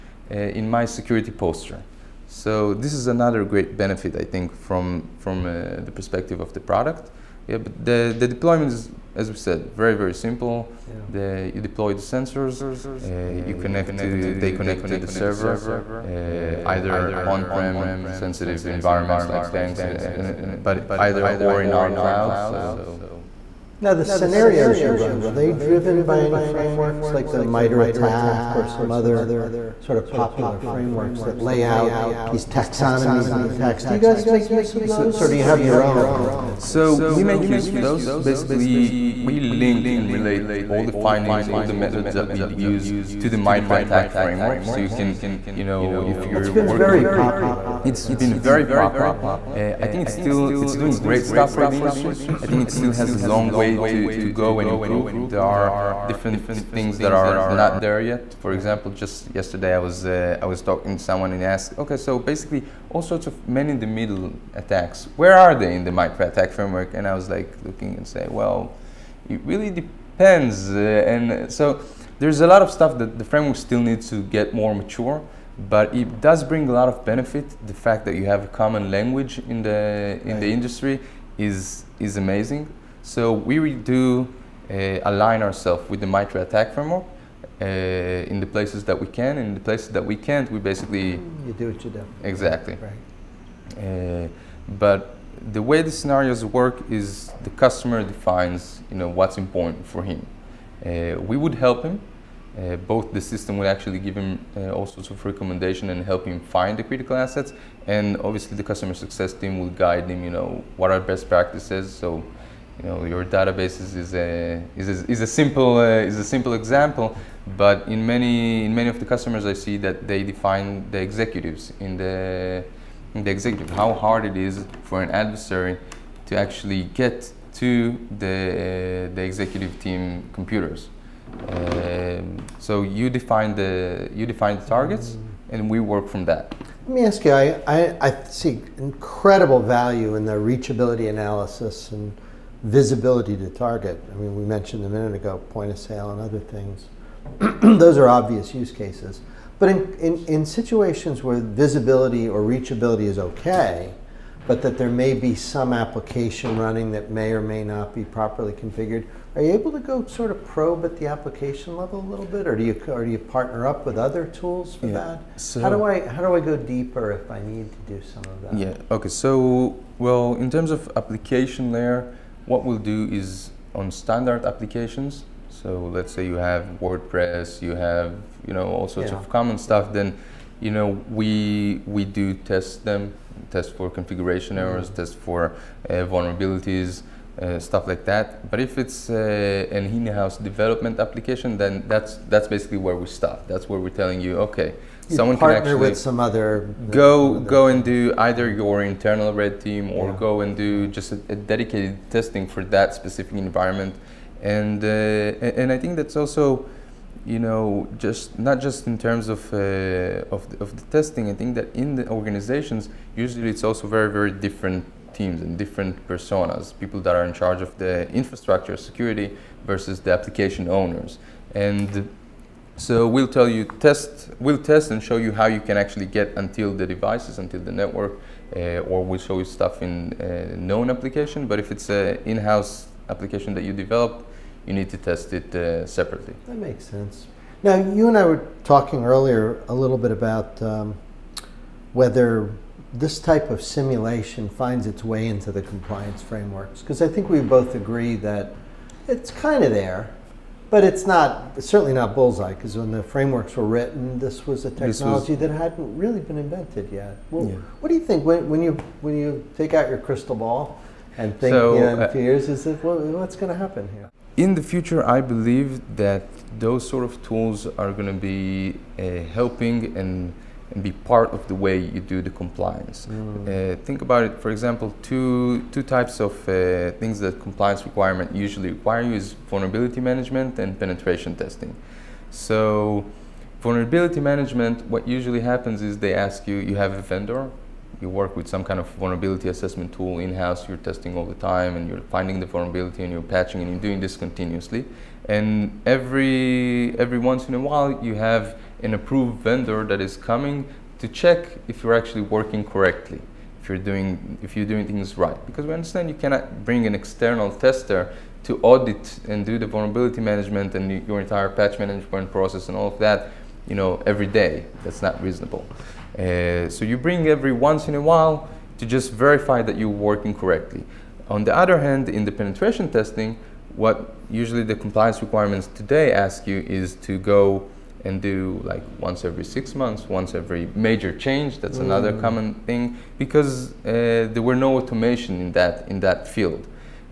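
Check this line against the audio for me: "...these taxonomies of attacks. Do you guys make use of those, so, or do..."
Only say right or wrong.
right.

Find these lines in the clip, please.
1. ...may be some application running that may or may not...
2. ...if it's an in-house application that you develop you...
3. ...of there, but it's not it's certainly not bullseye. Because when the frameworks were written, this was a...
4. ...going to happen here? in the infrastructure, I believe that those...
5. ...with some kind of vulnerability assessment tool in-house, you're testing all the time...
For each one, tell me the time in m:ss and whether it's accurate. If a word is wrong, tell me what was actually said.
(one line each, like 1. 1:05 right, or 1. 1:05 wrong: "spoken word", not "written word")
1. 2:34 right
2. 3:51 right
3. 4:09 right
4. 4:23 wrong: "future", not "infrastructure"
5. 4:48 right.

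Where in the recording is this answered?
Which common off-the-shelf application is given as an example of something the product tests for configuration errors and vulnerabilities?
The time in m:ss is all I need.
2:56.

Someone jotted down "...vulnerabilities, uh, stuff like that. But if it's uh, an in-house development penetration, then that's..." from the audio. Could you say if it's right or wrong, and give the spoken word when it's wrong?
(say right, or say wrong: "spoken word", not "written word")
wrong: "application", not "penetration".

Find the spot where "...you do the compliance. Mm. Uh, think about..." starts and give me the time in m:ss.
4:31.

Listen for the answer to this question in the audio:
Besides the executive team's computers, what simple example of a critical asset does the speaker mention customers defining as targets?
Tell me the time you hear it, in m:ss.
1:53.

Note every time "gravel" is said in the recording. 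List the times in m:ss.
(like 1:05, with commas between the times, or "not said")
not said.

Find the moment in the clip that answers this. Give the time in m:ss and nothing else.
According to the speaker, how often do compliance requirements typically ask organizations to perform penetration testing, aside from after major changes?
5:28.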